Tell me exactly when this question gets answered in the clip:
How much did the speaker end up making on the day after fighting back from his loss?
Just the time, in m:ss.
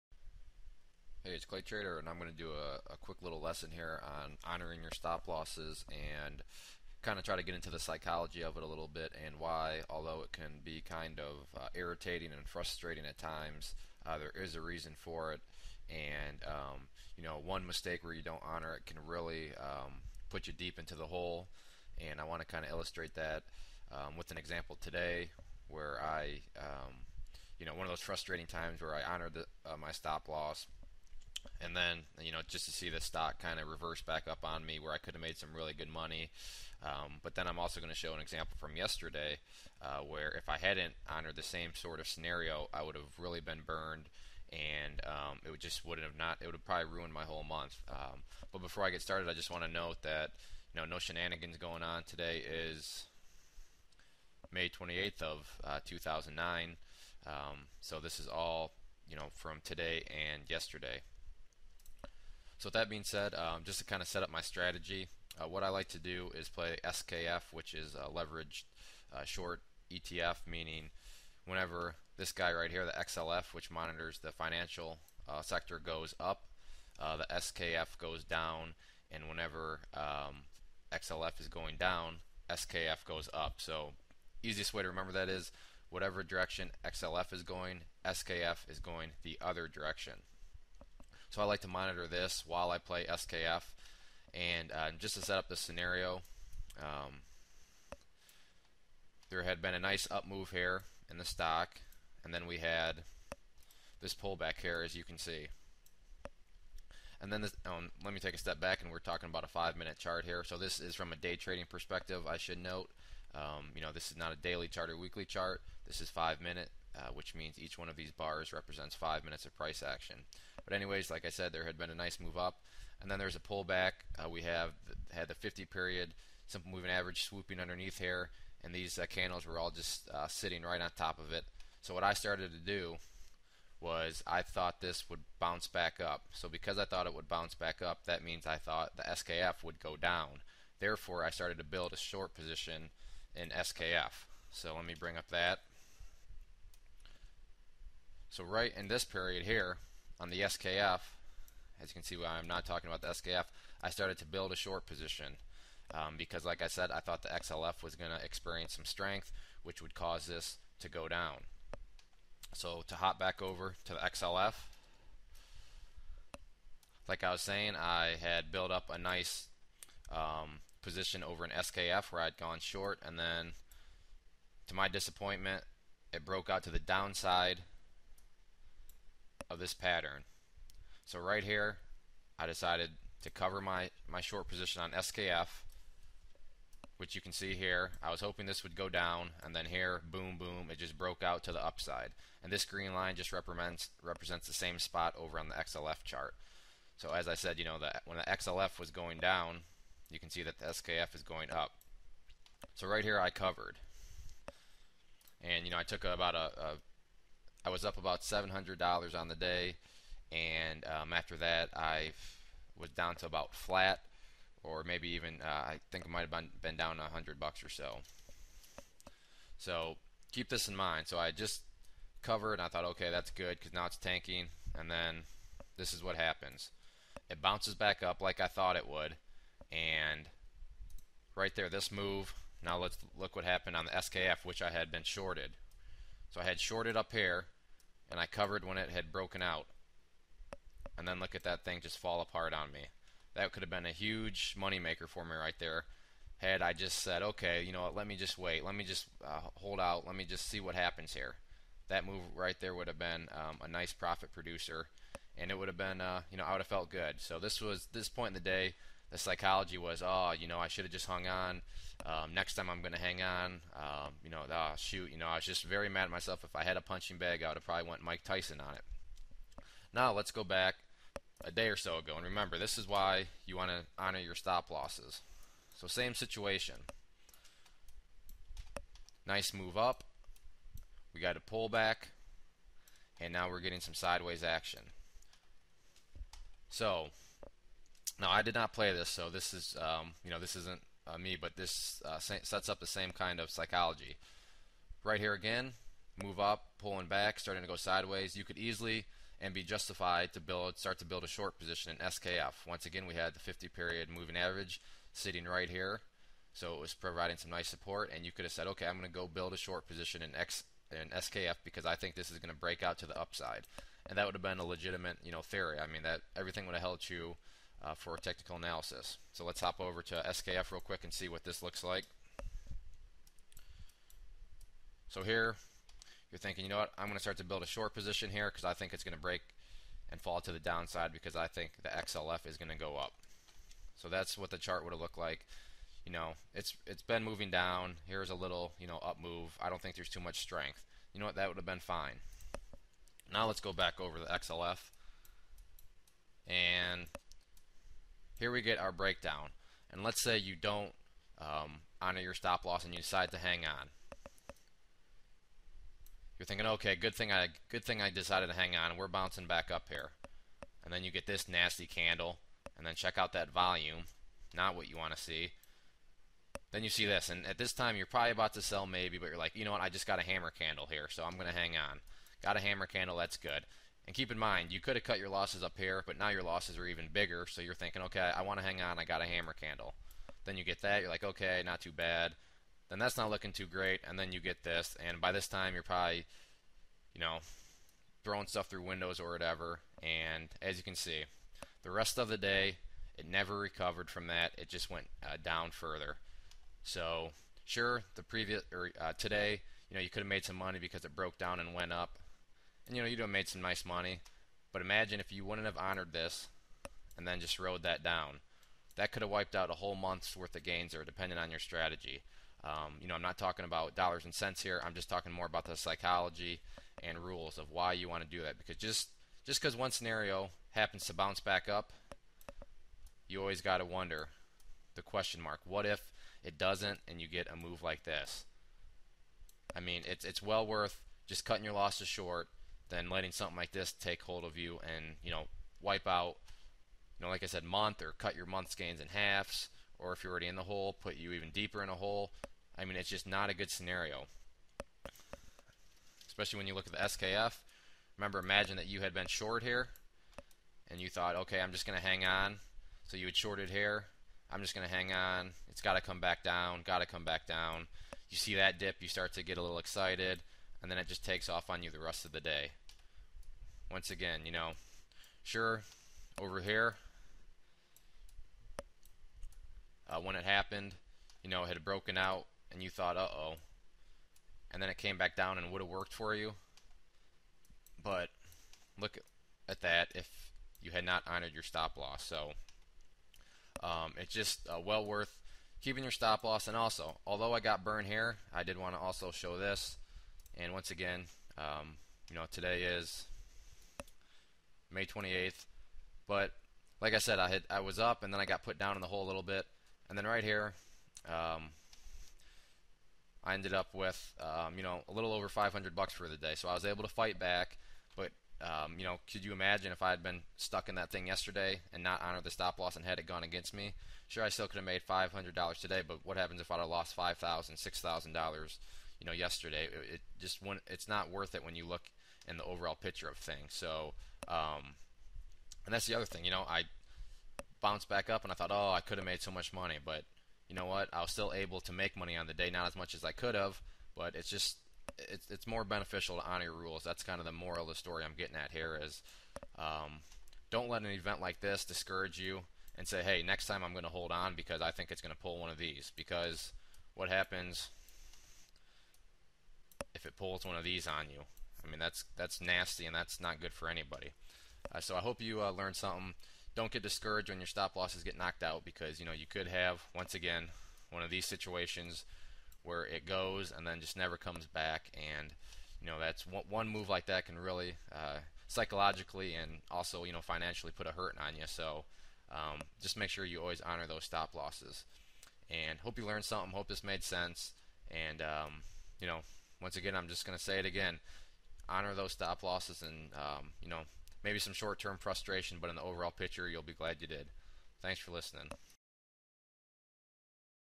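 8:25.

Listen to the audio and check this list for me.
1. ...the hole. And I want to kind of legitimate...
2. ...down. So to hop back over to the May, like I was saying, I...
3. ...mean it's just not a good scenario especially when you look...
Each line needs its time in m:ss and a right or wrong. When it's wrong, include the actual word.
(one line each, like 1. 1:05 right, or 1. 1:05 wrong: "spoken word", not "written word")
1. 0:20 wrong: "illustrate", not "legitimate"
2. 2:41 wrong: "XLF", not "May"
3. 7:22 right.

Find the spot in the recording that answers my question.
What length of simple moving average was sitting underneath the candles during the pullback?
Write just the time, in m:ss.
2:05.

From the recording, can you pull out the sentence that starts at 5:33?
So that's what the chart would have looked like.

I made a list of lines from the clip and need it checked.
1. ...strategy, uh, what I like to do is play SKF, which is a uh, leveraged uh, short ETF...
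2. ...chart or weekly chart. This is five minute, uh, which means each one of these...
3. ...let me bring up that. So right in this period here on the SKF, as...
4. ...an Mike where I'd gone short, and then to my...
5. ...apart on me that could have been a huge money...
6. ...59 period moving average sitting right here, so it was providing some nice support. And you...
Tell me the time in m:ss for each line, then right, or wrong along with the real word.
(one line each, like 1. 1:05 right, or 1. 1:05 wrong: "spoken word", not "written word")
1. 1:04 right
2. 1:54 right
3. 2:24 right
4. 2:51 wrong: "SKF", not "Mike"
5. 4:02 right
6. 5:03 wrong: "50", not "59".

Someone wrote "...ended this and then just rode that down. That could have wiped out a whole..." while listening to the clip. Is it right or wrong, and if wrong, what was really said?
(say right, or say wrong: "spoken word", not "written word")
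wrong: "honored", not "ended".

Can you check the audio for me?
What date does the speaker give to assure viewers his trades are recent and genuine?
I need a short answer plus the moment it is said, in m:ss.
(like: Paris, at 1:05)
May 28th, 2009, at 0:54.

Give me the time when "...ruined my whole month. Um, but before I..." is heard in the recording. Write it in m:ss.
0:46.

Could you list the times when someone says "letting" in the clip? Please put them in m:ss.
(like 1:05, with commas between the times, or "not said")
7:13.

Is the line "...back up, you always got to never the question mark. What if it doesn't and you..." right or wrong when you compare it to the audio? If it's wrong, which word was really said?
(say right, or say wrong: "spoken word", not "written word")
wrong: "wonder", not "never".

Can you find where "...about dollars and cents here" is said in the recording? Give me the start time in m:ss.
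6:53.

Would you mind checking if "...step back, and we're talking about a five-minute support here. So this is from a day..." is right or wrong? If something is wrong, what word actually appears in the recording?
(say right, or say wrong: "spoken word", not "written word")
wrong: "chart", not "support".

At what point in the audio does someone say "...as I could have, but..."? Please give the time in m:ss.
8:53.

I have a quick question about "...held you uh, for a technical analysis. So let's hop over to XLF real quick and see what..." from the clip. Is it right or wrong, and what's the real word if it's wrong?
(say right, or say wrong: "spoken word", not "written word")
wrong: "SKF", not "XLF".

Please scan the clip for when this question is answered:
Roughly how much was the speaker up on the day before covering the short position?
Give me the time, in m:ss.
3:28.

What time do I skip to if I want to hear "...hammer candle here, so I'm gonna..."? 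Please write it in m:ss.
6:10.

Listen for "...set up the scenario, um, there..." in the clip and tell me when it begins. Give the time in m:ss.
1:35.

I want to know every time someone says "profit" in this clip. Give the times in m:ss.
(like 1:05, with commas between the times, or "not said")
4:13.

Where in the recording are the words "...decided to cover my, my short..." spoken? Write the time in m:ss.
3:02.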